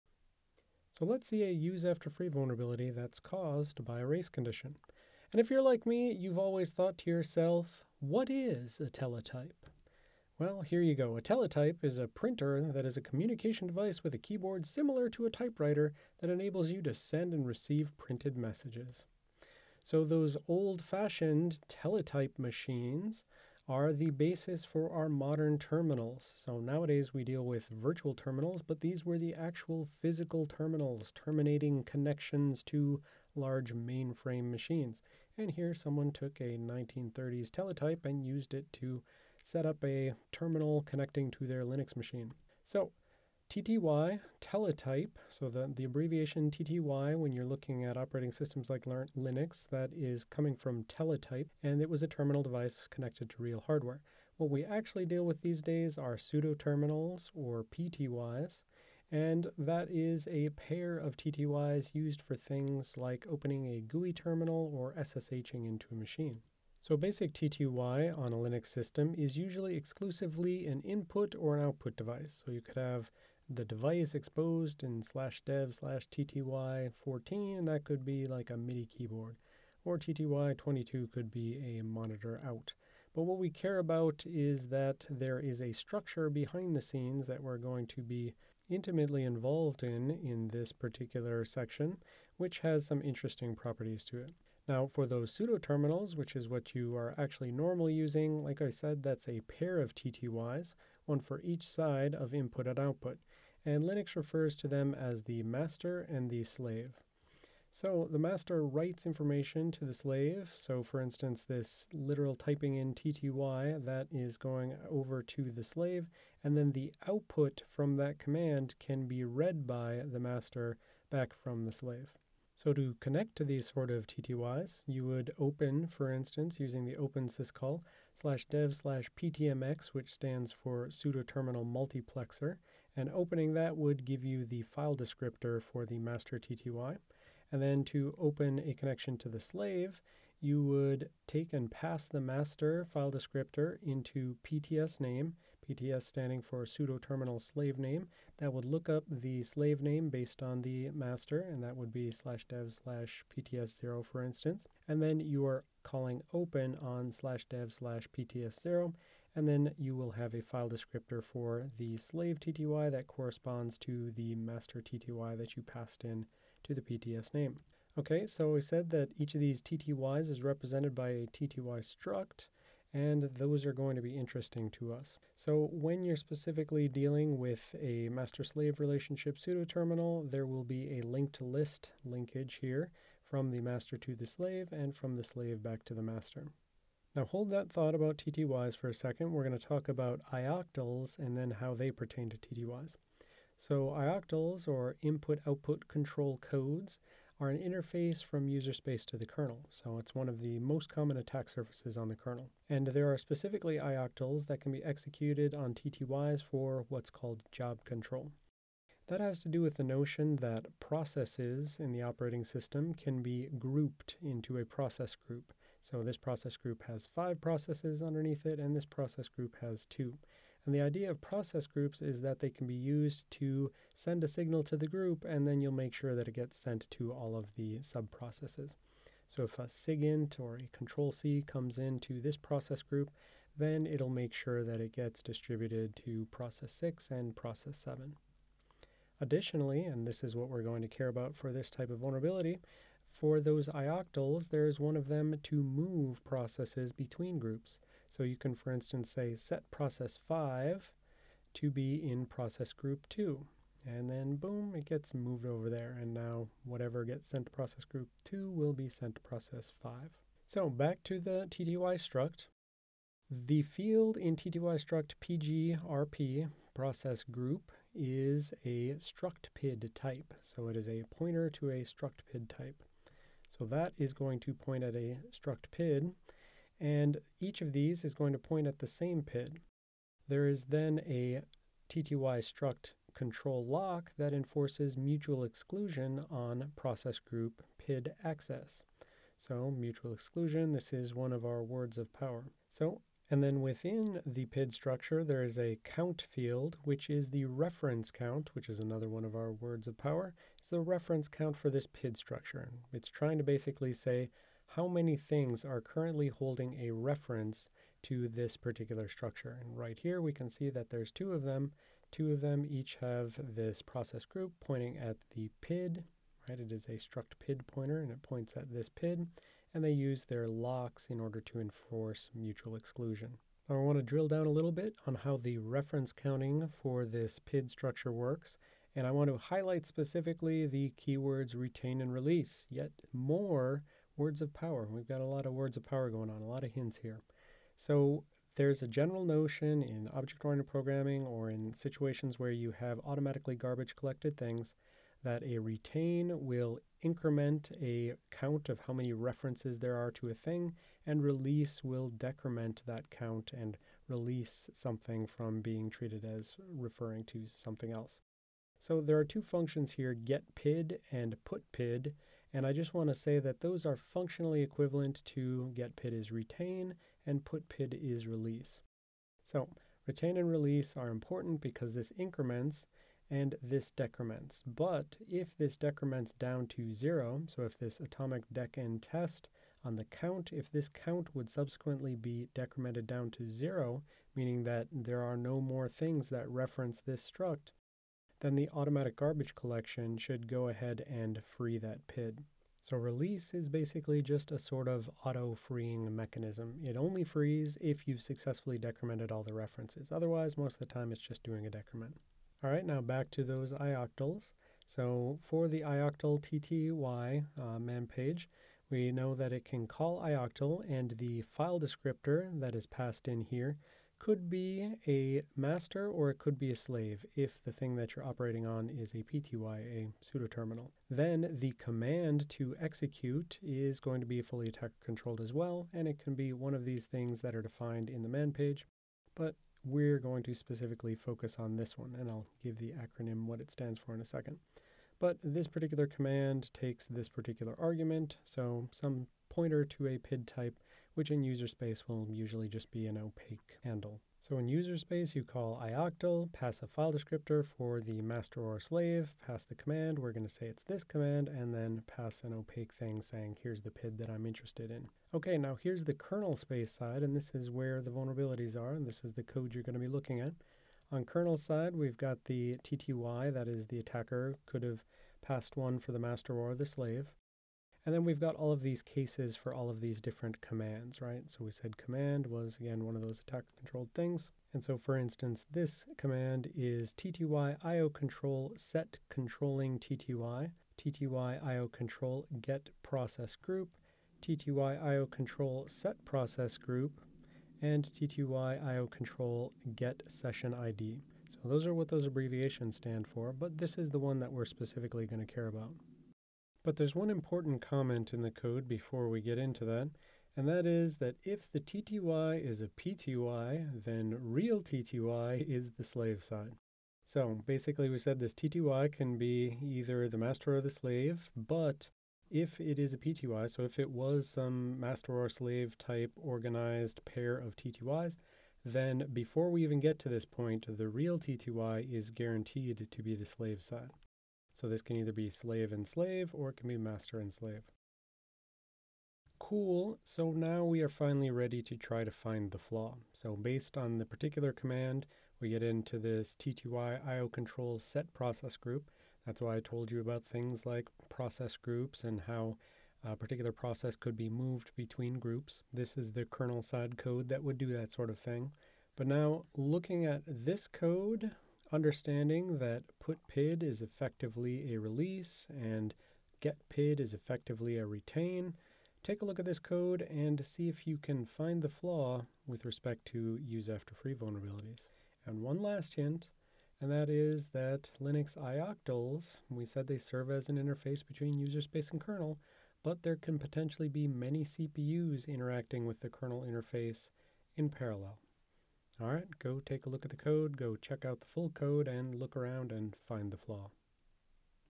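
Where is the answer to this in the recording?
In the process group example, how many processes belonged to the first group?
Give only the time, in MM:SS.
03:37.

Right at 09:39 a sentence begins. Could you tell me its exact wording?
All right, go take a look at the code, go check out the full code, and look around and find the flaw.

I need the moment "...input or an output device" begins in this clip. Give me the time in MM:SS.
01:10.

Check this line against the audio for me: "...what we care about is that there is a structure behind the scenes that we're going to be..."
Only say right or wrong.
right.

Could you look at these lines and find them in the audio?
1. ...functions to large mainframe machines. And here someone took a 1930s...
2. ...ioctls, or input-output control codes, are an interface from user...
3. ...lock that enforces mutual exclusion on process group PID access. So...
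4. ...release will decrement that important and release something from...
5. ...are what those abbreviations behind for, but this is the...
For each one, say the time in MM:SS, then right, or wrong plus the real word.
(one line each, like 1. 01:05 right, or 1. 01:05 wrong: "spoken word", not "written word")
1. 00:31 wrong: "connections", not "functions"
2. 03:13 right
3. 04:43 right
4. 05:51 wrong: "count", not "important"
5. 08:11 wrong: "stand", not "behind".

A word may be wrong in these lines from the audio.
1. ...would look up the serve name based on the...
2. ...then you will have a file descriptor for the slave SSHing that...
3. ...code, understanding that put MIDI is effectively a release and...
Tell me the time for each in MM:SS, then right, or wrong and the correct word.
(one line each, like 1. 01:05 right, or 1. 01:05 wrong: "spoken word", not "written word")
1. 02:28 wrong: "slave", not "serve"
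2. 02:39 wrong: "TTY", not "SSHing"
3. 09:10 wrong: "PID", not "MIDI".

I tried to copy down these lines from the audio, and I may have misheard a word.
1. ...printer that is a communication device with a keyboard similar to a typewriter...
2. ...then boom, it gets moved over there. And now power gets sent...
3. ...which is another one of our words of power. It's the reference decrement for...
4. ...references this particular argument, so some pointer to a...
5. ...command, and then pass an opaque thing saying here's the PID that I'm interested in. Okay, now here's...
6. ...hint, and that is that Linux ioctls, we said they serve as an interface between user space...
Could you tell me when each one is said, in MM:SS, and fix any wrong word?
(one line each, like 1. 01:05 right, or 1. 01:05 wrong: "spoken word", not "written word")
1. 00:12 right
2. 04:14 wrong: "whatever", not "power"
3. 04:58 wrong: "count", not "decrement"
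4. 07:16 wrong: "takes", not "references"
5. 07:31 right
6. 09:26 right.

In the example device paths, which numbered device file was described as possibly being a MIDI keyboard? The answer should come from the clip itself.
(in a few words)
tty14.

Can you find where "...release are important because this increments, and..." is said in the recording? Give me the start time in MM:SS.
06:10.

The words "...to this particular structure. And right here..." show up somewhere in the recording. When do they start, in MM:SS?
05:08.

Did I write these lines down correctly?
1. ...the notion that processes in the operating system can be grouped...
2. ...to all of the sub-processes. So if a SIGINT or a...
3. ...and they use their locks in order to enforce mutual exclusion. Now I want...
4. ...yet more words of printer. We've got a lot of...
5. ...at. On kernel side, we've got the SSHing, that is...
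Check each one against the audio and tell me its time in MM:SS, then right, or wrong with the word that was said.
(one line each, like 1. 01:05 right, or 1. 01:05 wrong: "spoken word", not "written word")
1. 03:29 right
2. 03:46 right
3. 05:19 right
4. 05:32 wrong: "power", not "printer"
5. 07:40 wrong: "TTY", not "SSHing".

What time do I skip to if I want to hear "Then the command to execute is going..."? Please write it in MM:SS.
07:01.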